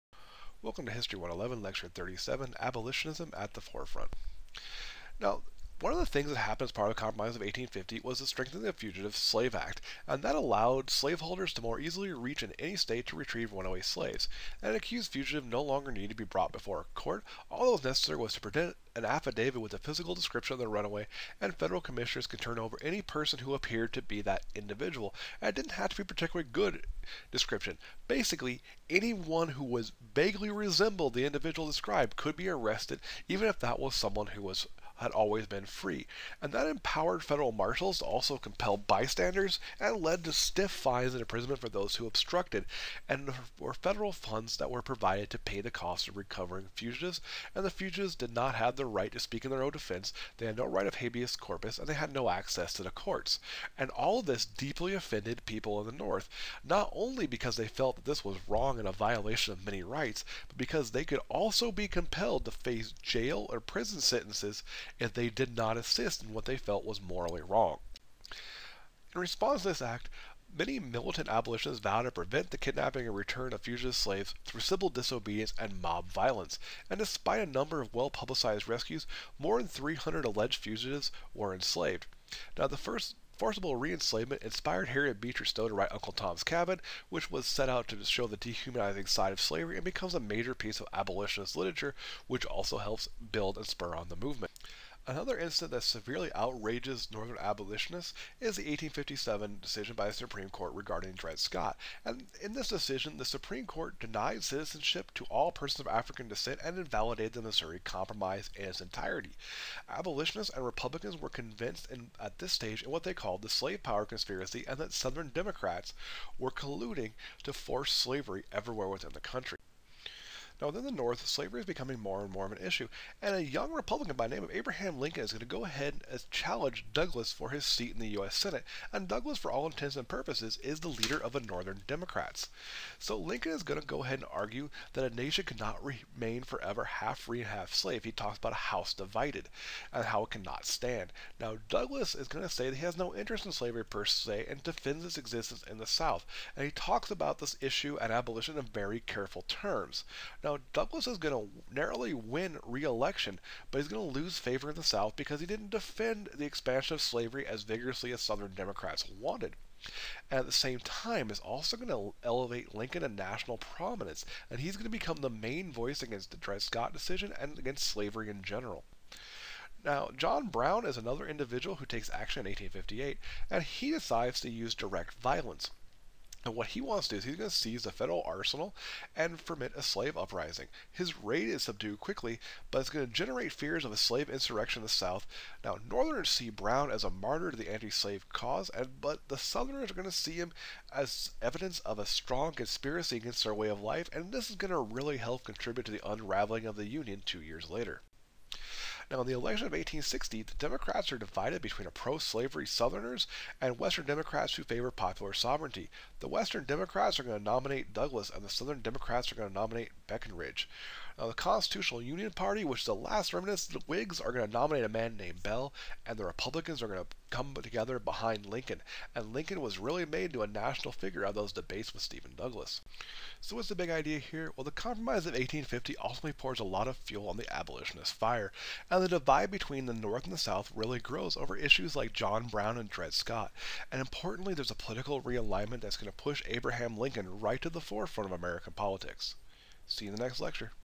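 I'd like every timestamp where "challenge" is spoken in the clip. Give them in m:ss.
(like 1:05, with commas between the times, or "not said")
2:06.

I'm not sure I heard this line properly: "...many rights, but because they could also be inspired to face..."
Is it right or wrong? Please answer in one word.
wrong.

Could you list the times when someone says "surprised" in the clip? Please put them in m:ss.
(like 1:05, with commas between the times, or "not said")
not said.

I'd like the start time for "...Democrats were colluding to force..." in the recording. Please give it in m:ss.
1:55.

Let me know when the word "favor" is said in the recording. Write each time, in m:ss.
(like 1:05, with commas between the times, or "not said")
2:34, 3:24.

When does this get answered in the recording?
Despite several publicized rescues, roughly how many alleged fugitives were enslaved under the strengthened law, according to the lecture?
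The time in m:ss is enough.
1:19.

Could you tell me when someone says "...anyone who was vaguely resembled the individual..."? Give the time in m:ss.
0:28.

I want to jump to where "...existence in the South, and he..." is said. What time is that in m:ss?
2:25.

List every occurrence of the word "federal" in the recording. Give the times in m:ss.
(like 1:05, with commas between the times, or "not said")
0:21, 0:37, 0:43, 2:57.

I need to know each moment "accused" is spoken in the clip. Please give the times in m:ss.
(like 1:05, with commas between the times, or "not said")
0:14.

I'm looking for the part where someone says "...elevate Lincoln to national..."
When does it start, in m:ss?
2:42.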